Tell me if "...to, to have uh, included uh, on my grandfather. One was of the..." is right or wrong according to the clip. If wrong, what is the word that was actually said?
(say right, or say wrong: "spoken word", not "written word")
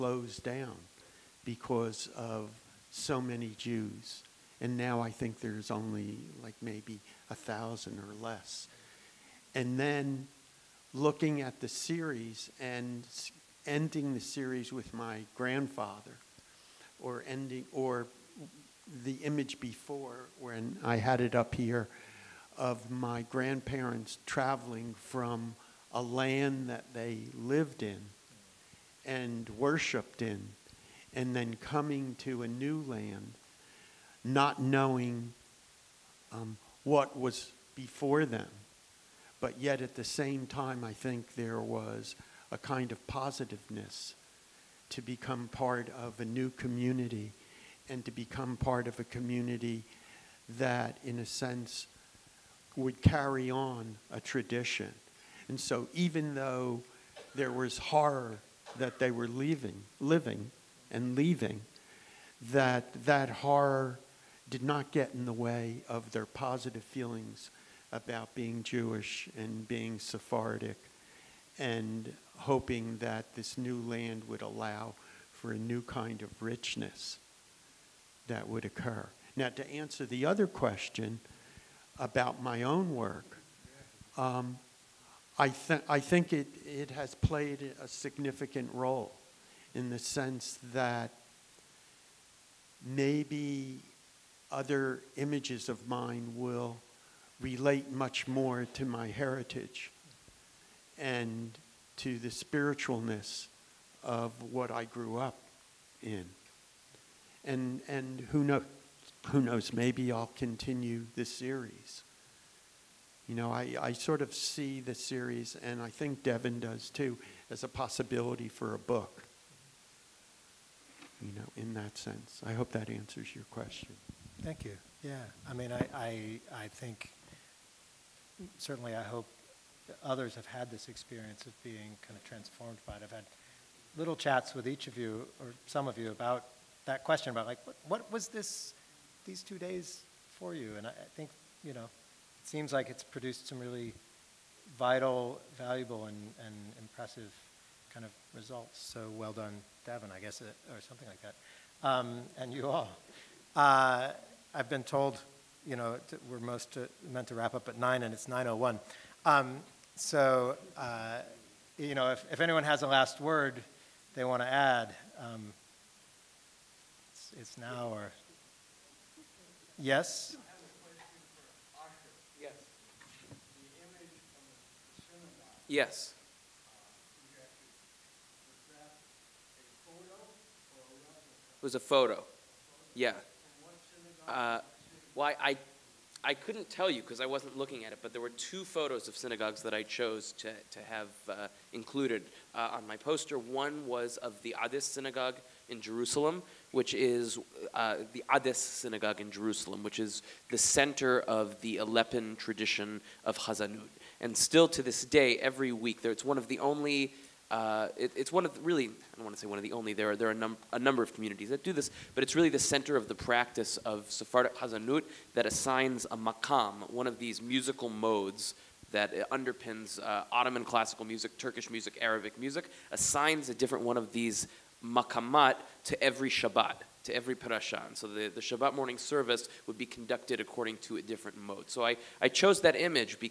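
wrong: "poster", not "grandfather".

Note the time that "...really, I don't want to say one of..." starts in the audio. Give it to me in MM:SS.
03:28.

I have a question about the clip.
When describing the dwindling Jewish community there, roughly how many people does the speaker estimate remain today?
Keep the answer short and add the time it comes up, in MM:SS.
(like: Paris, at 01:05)
1000, at 00:07.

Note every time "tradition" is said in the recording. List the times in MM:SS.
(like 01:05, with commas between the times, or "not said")
00:54, 03:22.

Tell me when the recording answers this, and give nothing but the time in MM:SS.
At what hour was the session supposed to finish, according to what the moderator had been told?
02:37.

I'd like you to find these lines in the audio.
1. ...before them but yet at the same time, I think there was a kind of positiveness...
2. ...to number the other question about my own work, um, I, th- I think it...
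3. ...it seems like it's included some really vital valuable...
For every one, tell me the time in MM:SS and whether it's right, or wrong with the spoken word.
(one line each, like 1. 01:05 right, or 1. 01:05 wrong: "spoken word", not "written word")
1. 00:37 right
2. 01:19 wrong: "answer", not "number"
3. 02:21 wrong: "produced", not "included".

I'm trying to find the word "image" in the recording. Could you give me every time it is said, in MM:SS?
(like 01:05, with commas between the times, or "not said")
00:19, 01:35, 03:52.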